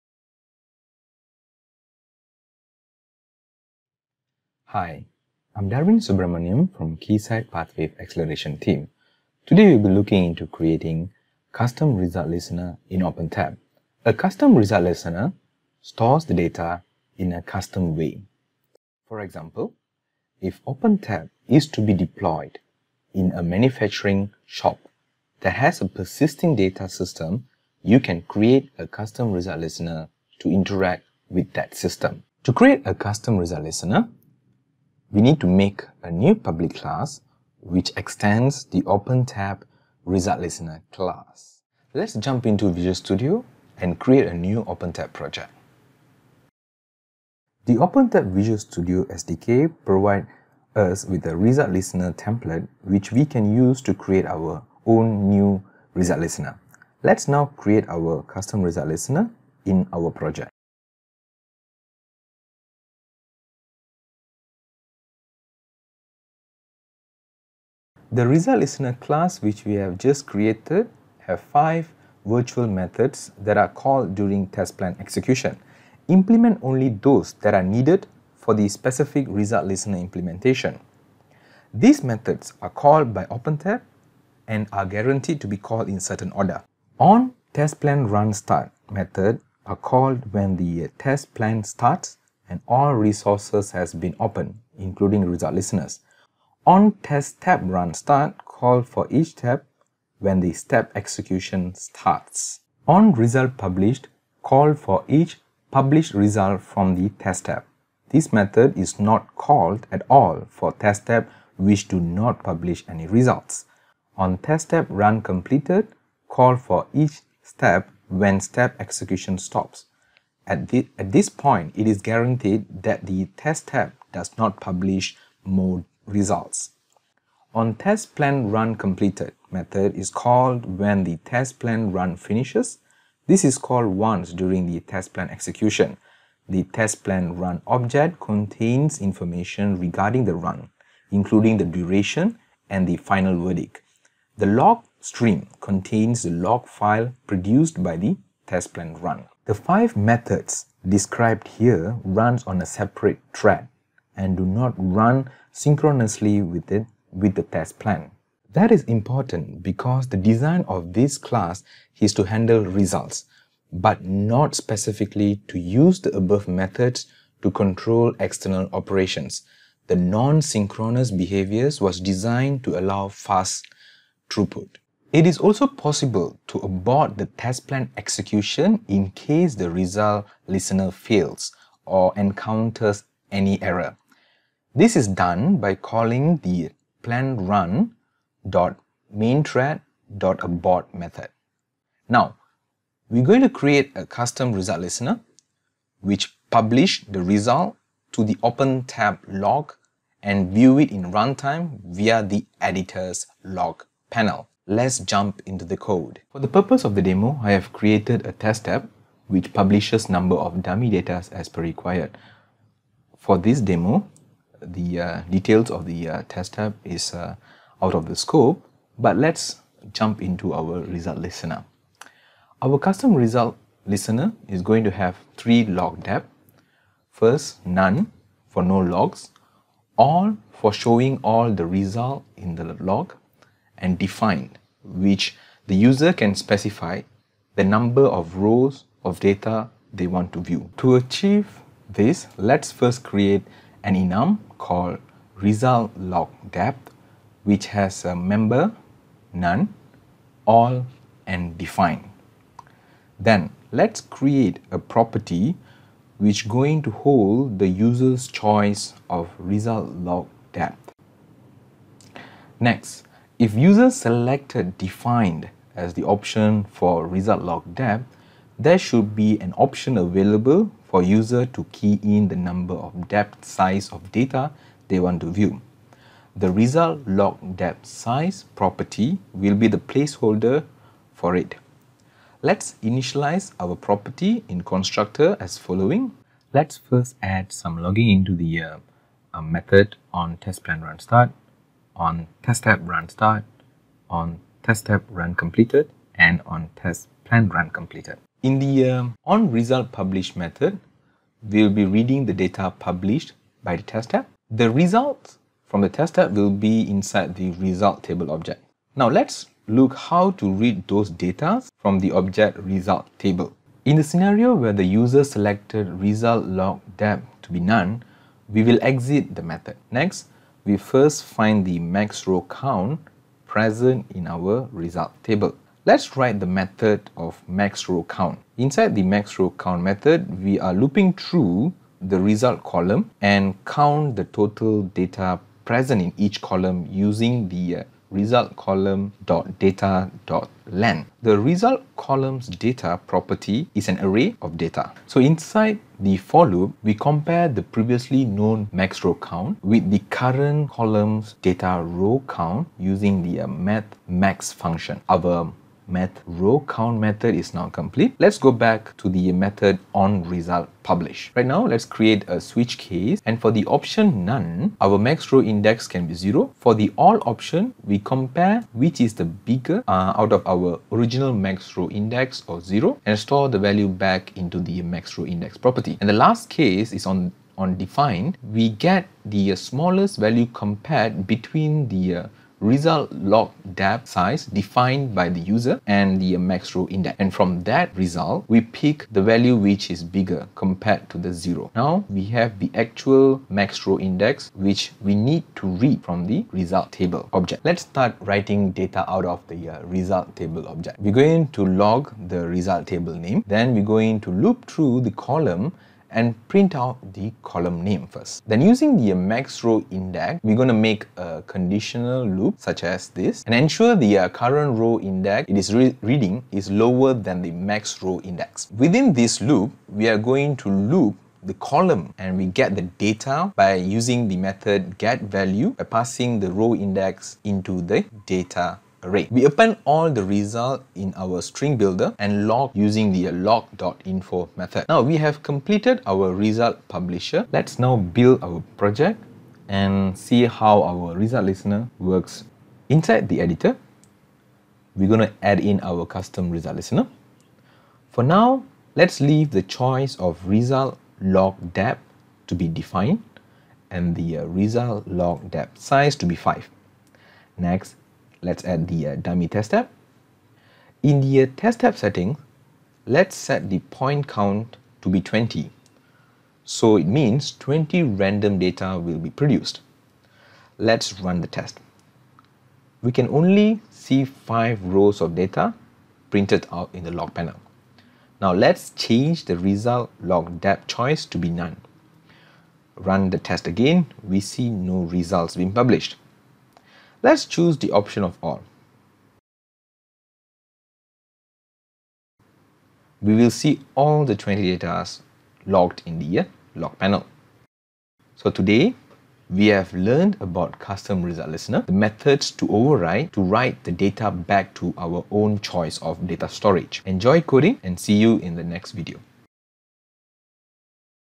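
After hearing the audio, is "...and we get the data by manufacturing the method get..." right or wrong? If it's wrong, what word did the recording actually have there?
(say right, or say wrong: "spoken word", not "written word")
wrong: "using", not "manufacturing".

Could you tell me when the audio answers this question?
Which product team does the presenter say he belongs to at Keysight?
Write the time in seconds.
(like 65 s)
6 s.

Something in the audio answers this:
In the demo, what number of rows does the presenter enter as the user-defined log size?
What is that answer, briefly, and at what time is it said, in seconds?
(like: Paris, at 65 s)
5, at 454 s.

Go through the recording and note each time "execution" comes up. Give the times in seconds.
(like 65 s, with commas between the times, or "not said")
74 s, 100 s, 118 s, 135 s, 177 s.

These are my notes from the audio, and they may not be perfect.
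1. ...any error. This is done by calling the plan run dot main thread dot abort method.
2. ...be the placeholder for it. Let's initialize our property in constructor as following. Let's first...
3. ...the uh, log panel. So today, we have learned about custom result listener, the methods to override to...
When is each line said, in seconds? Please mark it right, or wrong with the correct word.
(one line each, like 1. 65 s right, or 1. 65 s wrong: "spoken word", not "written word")
1. 183 s right
2. 279 s right
3. 496 s right.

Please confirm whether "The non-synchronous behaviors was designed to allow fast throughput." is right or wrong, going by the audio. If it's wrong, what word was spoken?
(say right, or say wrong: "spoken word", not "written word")
right.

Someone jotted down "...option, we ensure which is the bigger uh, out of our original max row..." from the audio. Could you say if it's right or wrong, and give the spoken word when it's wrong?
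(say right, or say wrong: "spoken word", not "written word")
wrong: "compare", not "ensure".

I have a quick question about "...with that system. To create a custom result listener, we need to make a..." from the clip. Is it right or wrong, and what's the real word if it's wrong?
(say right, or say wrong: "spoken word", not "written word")
right.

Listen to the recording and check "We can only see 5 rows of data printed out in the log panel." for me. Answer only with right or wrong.
right.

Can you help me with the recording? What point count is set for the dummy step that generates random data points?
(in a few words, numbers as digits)
20.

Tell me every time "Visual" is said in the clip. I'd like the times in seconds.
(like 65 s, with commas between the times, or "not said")
42 s, 48 s.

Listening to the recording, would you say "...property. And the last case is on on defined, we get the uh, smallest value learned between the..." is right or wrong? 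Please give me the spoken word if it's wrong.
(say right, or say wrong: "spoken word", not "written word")
wrong: "compared", not "learned".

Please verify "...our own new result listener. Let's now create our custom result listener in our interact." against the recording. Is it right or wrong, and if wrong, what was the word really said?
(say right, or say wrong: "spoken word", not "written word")
wrong: "project", not "interact".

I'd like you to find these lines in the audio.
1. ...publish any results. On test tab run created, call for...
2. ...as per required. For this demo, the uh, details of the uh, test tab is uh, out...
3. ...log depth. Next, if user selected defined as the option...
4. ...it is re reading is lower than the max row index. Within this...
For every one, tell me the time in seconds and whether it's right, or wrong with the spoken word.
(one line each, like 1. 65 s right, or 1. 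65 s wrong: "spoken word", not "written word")
1. 112 s wrong: "completed", not "created"
2. 211 s right
3. 259 s right
4. 415 s right.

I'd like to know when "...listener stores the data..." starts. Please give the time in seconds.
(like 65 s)
14 s.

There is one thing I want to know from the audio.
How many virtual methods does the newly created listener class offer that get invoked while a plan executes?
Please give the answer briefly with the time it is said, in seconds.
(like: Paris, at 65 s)
5, at 71 s.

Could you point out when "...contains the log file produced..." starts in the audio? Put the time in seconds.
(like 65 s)
145 s.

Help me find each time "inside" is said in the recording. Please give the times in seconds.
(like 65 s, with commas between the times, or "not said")
306 s, 328 s, 345 s, 442 s.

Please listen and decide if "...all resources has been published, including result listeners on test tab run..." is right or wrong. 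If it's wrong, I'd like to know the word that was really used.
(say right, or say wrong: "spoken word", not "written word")
wrong: "opened", not "published".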